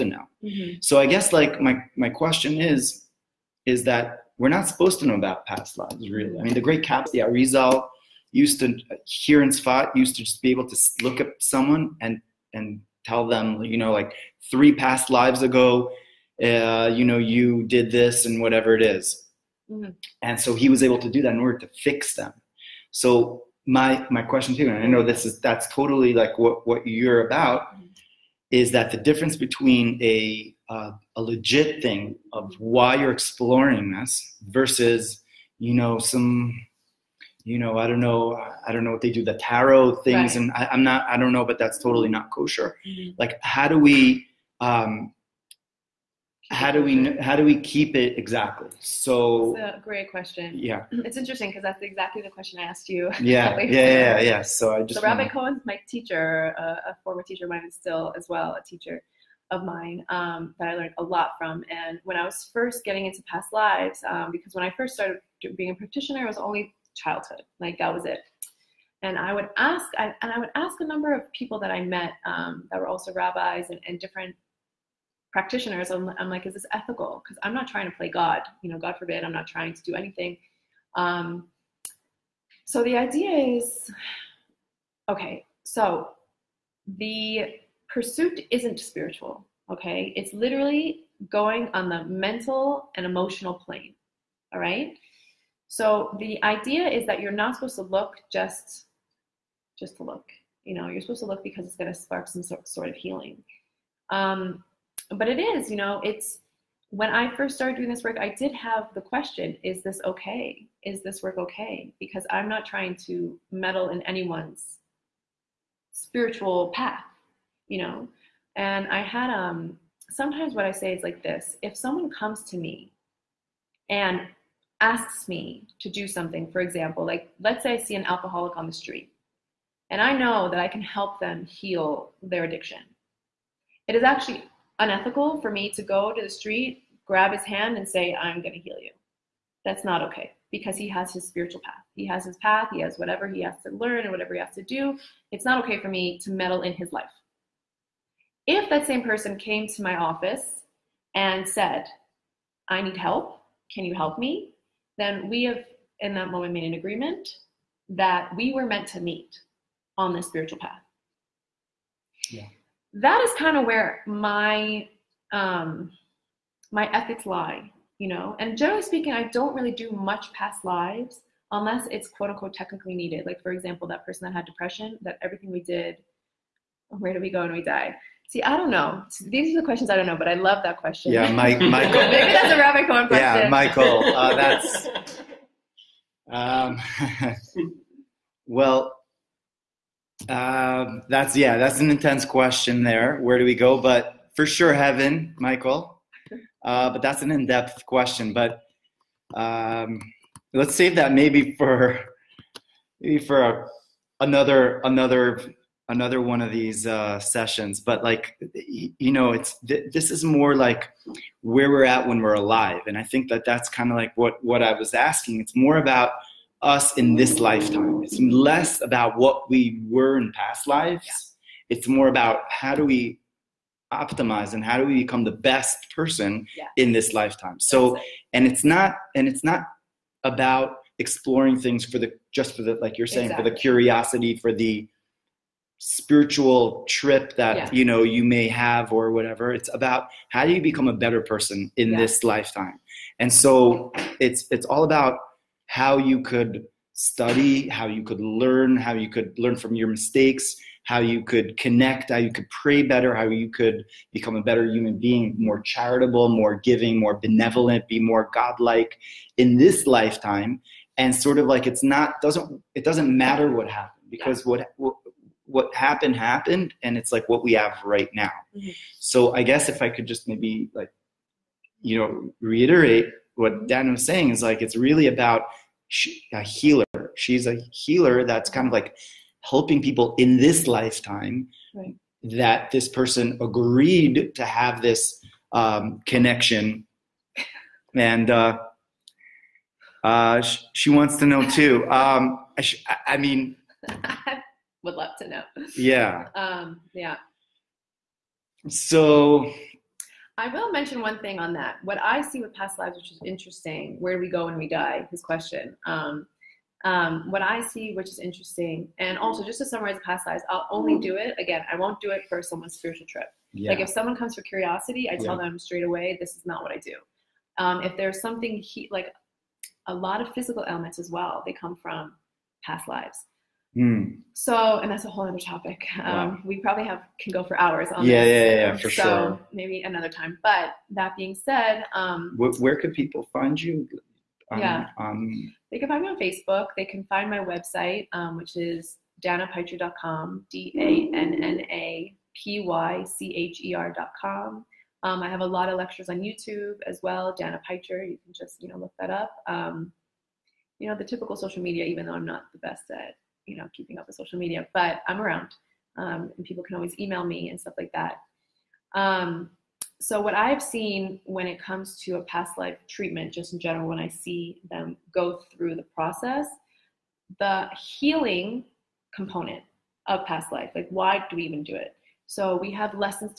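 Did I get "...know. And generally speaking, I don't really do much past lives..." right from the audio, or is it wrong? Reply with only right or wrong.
right.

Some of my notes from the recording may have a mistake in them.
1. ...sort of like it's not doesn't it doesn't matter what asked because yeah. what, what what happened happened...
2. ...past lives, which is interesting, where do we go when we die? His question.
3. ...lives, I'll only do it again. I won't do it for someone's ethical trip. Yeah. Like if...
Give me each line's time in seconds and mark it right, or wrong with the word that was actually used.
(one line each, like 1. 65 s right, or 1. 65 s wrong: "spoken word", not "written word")
1. 261 s wrong: "happened", not "asked"
2. 302 s right
3. 310 s wrong: "spiritual", not "ethical".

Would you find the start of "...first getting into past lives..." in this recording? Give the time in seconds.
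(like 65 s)
62 s.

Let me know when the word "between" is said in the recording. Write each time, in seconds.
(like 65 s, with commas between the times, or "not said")
29 s.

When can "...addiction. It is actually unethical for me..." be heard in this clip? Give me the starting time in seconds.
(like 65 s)
132 s.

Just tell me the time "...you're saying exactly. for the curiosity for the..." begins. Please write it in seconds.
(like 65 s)
232 s.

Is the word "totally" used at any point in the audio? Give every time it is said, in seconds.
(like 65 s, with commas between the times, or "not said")
25 s, 41 s.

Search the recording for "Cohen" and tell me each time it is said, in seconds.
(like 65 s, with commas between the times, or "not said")
55 s, 182 s.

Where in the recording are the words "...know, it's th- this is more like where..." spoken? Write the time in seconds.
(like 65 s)
209 s.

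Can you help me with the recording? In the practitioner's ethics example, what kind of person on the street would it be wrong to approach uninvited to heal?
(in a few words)
An alcoholic.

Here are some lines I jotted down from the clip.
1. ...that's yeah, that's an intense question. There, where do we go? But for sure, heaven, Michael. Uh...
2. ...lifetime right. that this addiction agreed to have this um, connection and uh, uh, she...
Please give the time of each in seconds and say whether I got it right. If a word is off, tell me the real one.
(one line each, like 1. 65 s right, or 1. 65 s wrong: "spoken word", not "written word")
1. 191 s right
2. 280 s wrong: "person", not "addiction".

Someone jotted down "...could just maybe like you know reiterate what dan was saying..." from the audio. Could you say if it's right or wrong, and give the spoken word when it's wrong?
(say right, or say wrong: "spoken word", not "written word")
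right.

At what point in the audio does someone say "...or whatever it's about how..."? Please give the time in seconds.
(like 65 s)
238 s.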